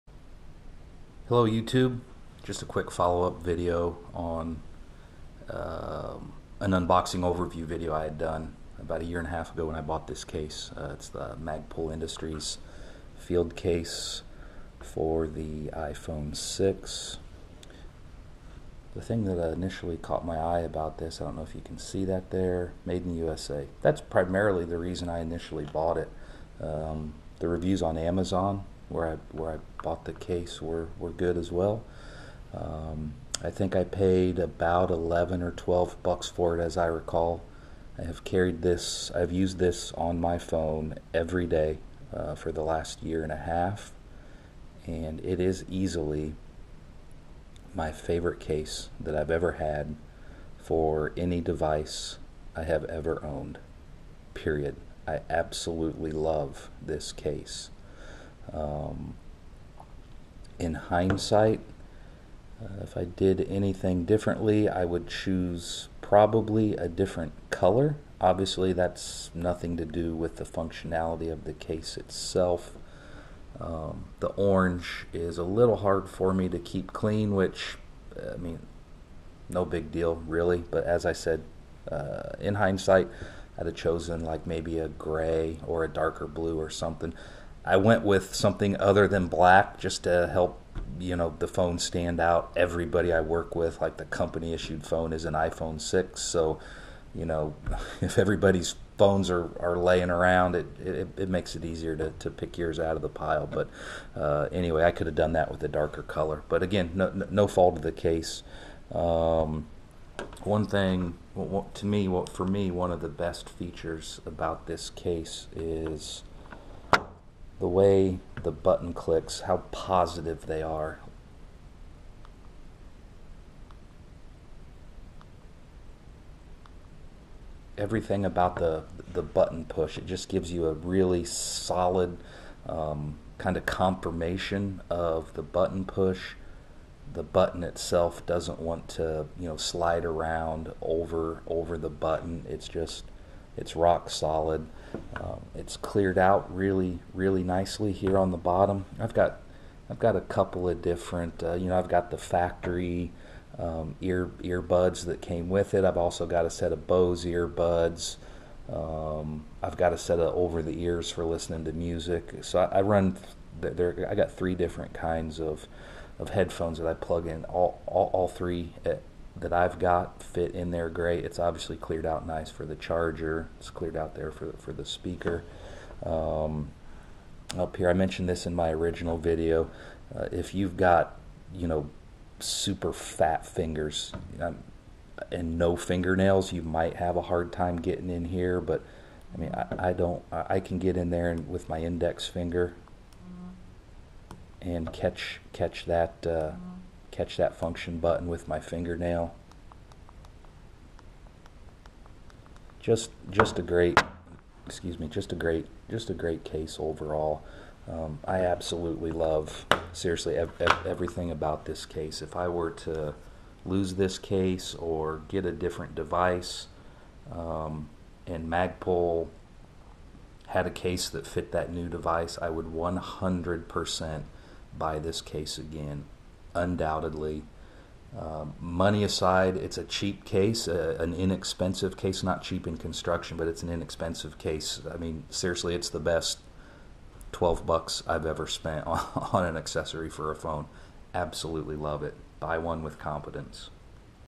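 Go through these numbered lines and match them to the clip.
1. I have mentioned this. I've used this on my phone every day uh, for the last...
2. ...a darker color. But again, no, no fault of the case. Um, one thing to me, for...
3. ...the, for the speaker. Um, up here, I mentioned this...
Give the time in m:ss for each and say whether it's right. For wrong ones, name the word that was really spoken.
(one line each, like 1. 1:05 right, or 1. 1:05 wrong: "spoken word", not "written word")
1. 0:37 wrong: "carried", not "mentioned"
2. 1:45 right
3. 2:54 right.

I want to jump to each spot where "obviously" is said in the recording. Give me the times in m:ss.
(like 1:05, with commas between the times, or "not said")
1:08, 2:51.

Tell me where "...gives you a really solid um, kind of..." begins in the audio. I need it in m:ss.
2:10.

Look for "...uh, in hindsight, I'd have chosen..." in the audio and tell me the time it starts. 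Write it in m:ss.
1:21.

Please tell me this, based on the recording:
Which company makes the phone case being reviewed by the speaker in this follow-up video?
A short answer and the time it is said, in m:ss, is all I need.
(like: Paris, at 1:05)
Magpul Industries, at 0:11.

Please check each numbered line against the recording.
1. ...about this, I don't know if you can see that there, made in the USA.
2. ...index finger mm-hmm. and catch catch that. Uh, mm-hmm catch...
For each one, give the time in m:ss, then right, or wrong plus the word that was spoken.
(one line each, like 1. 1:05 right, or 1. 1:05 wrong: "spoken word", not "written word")
1. 0:20 right
2. 3:11 right.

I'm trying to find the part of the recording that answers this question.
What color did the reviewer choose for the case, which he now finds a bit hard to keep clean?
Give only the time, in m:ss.
1:14.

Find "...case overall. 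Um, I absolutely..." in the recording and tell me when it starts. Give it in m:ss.
3:26.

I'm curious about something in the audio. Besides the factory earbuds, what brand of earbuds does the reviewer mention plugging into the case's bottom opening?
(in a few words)
Bose.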